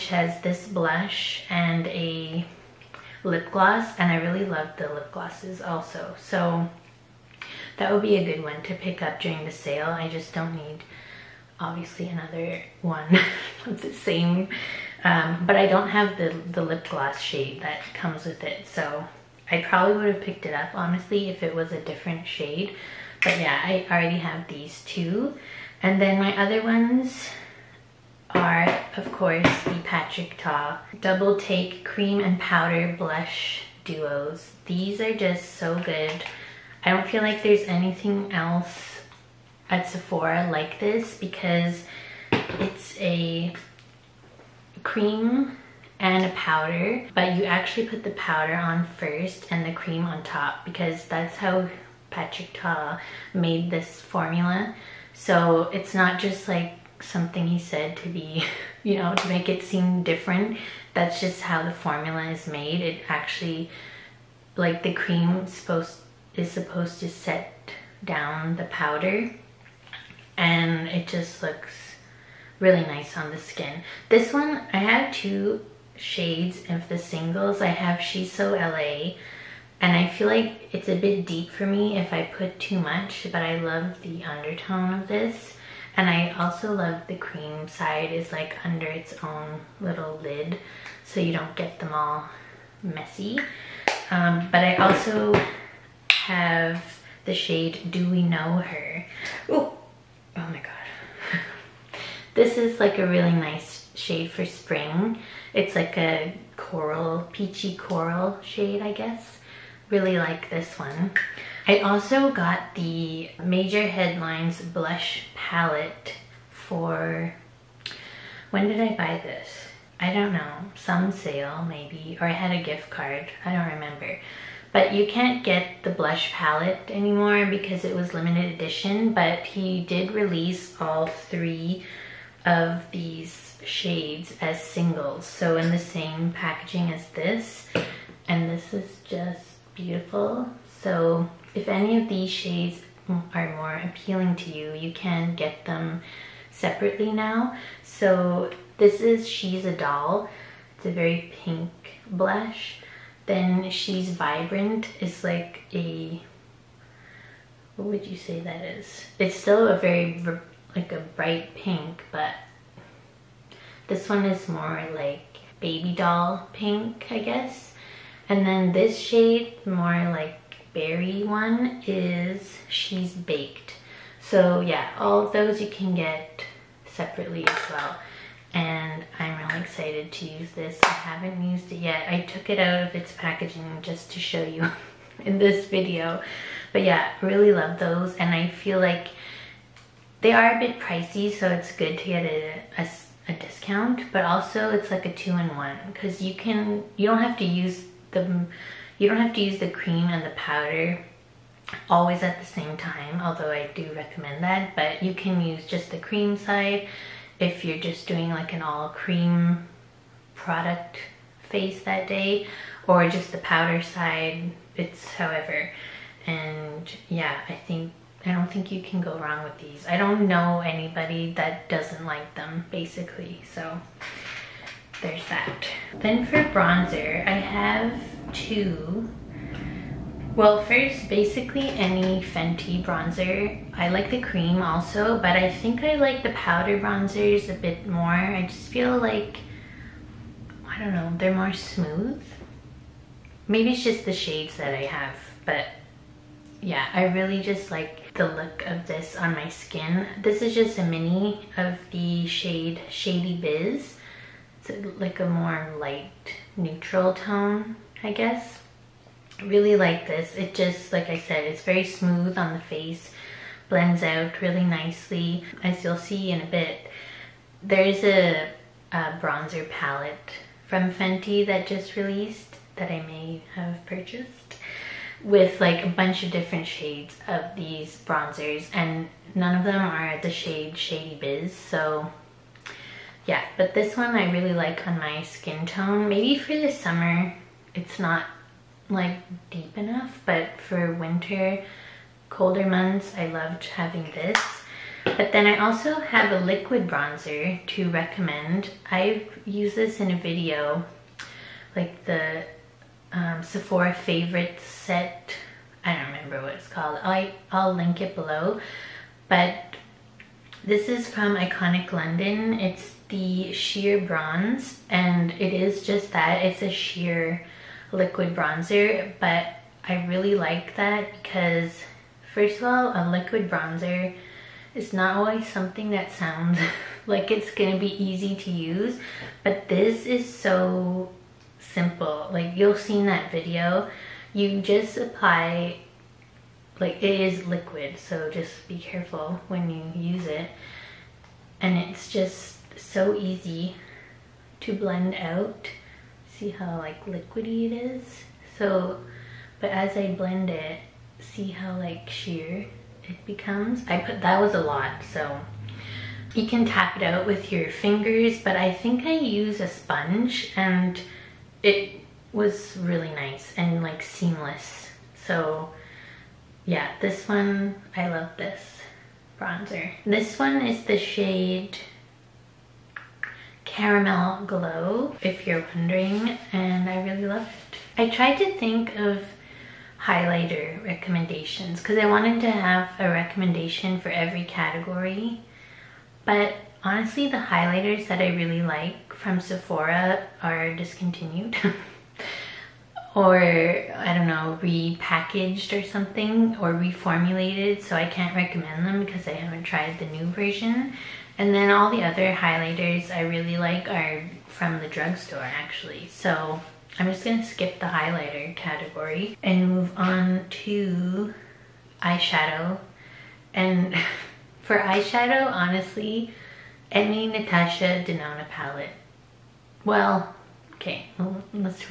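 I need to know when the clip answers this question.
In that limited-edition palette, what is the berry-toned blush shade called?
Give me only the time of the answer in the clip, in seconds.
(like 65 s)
172 s.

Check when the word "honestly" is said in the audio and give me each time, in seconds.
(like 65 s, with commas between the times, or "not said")
20 s, 386 s, 415 s.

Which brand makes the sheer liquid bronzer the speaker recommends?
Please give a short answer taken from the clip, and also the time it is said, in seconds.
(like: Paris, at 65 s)
Iconic London, at 311 s.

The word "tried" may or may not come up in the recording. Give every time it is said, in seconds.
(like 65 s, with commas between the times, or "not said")
378 s, 399 s.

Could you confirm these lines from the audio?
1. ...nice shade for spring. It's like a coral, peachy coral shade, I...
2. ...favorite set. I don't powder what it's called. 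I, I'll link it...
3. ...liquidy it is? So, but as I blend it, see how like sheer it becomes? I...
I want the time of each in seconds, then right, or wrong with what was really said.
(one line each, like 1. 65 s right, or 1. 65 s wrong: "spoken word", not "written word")
1. 103 s right
2. 303 s wrong: "remember", not "powder"
3. 347 s right.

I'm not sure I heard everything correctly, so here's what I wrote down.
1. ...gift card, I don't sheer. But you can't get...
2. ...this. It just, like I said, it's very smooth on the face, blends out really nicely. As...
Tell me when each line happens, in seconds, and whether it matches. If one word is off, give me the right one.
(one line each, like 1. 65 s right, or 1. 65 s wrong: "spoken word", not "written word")
1. 122 s wrong: "remember", not "sheer"
2. 260 s right.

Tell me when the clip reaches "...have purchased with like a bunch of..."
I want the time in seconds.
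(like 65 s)
273 s.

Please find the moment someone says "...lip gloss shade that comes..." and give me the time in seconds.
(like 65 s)
16 s.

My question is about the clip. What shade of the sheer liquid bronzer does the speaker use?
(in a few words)
Caramel Glow.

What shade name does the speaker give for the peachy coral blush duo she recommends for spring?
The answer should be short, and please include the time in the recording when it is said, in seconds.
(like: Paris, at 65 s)
Do We Know Her, at 97 s.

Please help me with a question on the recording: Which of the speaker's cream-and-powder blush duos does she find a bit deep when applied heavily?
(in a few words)
She's So LA.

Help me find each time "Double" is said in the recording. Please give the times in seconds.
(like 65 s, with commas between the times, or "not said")
30 s.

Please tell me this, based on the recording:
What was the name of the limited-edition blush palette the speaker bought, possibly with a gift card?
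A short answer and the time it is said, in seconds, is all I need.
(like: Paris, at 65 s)
Major Headlines, at 113 s.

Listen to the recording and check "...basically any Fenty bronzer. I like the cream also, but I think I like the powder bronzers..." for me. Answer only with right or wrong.
right.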